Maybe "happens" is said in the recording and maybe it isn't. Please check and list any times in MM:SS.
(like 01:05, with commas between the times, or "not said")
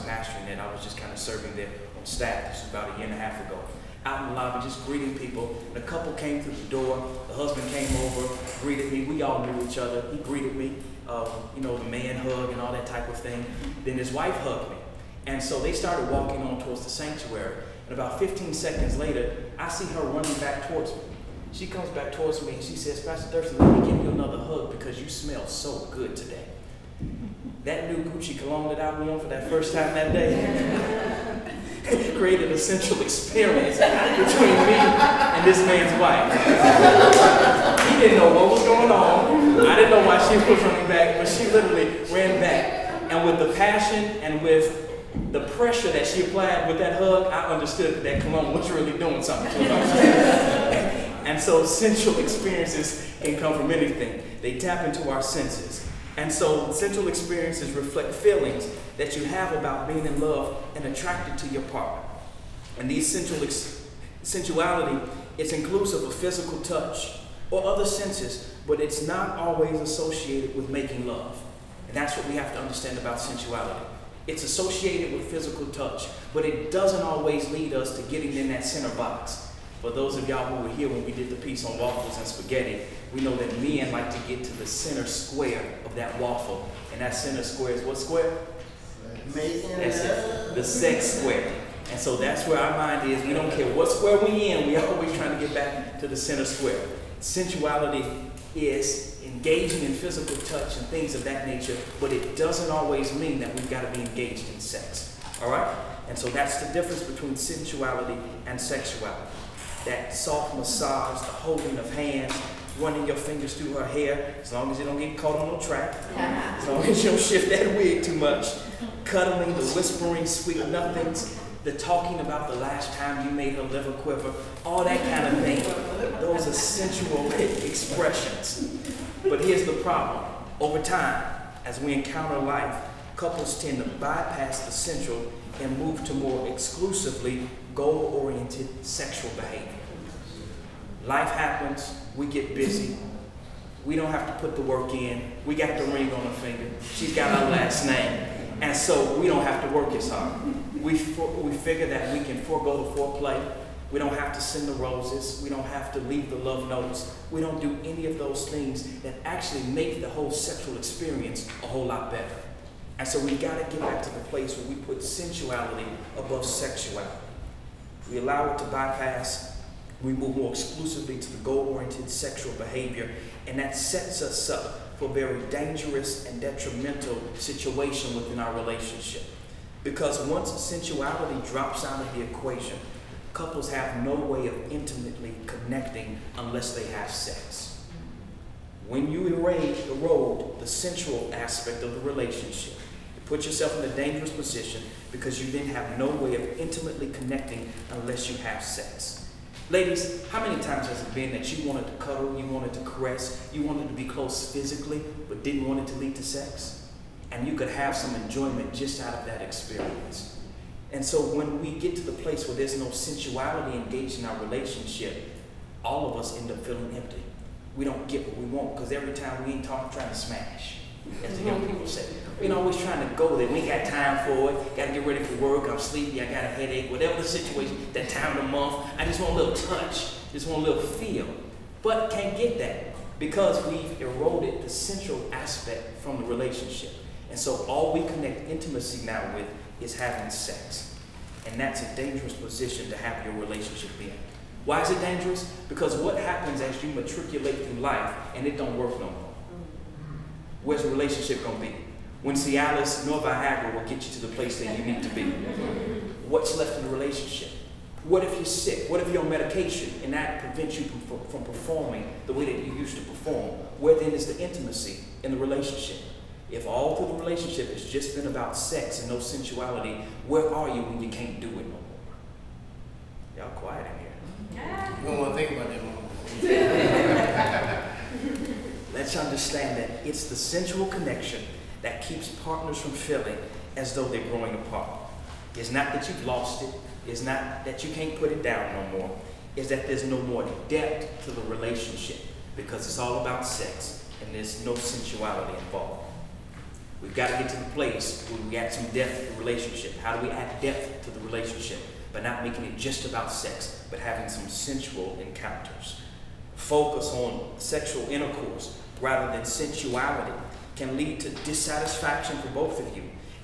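02:21, 04:06.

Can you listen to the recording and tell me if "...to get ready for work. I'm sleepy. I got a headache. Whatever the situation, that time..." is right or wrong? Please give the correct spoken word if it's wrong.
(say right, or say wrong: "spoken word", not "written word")
right.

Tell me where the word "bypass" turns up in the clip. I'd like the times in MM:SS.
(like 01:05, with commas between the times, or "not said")
02:13, 02:48.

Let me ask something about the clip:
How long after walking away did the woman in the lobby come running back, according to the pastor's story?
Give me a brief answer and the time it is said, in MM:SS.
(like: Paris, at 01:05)
15 seconds, at 00:18.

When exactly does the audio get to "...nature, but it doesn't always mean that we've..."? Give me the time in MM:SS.
01:41.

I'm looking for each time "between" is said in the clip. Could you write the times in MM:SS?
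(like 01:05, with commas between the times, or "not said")
00:33, 01:47.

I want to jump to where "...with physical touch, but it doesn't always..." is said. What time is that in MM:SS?
01:15.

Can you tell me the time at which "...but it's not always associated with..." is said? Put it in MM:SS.
01:08.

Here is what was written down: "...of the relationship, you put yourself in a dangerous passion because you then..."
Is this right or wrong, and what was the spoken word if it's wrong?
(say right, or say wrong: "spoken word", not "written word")
wrong: "position", not "passion".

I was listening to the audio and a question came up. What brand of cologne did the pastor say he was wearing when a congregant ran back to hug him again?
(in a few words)
Gucci.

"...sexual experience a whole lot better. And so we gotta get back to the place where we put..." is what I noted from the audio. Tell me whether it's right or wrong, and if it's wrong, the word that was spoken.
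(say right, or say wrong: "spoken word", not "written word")
right.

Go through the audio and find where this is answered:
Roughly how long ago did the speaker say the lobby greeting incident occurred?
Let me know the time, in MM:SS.
00:02.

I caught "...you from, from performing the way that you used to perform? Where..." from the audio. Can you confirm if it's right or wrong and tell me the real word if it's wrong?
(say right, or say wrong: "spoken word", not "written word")
right.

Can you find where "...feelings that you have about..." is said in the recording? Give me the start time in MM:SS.
00:58.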